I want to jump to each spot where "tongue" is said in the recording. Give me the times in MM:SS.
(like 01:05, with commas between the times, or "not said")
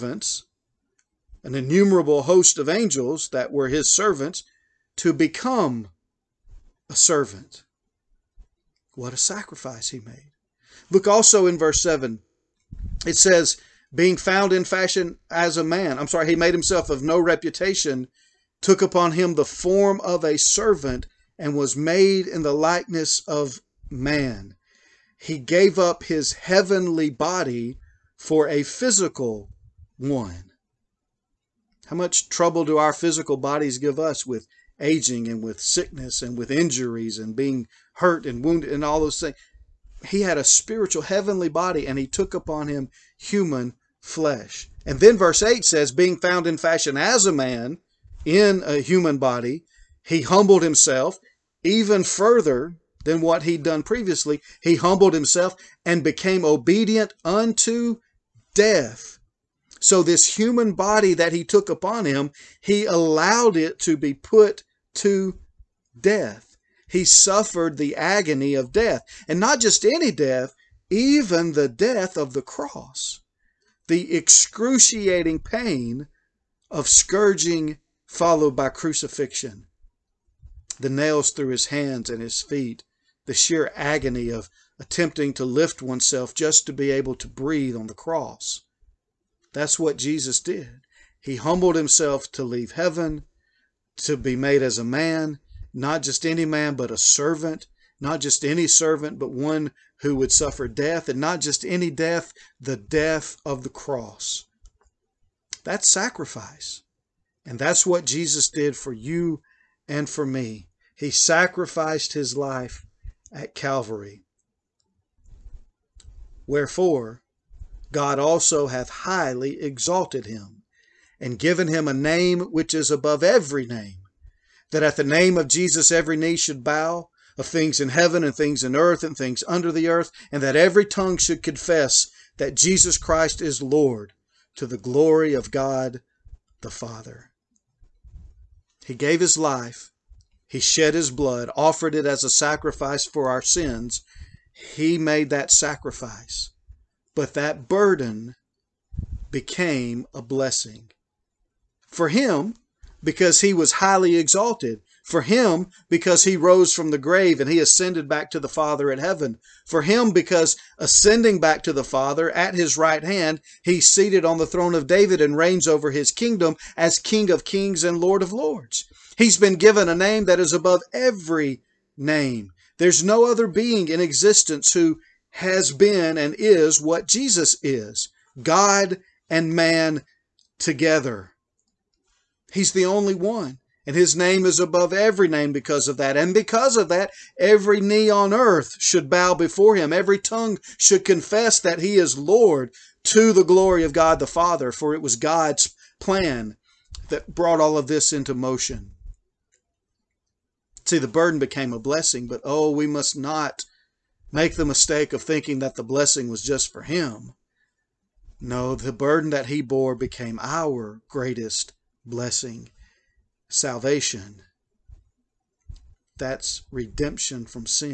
02:10, 03:10.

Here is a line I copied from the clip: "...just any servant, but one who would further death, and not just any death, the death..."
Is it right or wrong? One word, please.
wrong.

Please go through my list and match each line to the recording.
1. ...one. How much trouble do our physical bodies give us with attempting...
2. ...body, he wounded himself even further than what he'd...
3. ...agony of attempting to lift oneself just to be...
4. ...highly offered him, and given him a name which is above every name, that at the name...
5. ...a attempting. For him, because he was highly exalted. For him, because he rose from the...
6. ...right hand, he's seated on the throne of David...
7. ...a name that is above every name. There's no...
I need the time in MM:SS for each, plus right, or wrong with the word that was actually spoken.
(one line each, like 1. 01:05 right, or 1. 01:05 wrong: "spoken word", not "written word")
1. 00:29 wrong: "aging", not "attempting"
2. 00:49 wrong: "humbled", not "wounded"
3. 01:23 right
4. 01:58 wrong: "exalted", not "offered"
5. 02:30 wrong: "blessing", not "attempting"
6. 02:42 right
7. 02:49 right.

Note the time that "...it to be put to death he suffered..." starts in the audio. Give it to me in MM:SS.
01:03.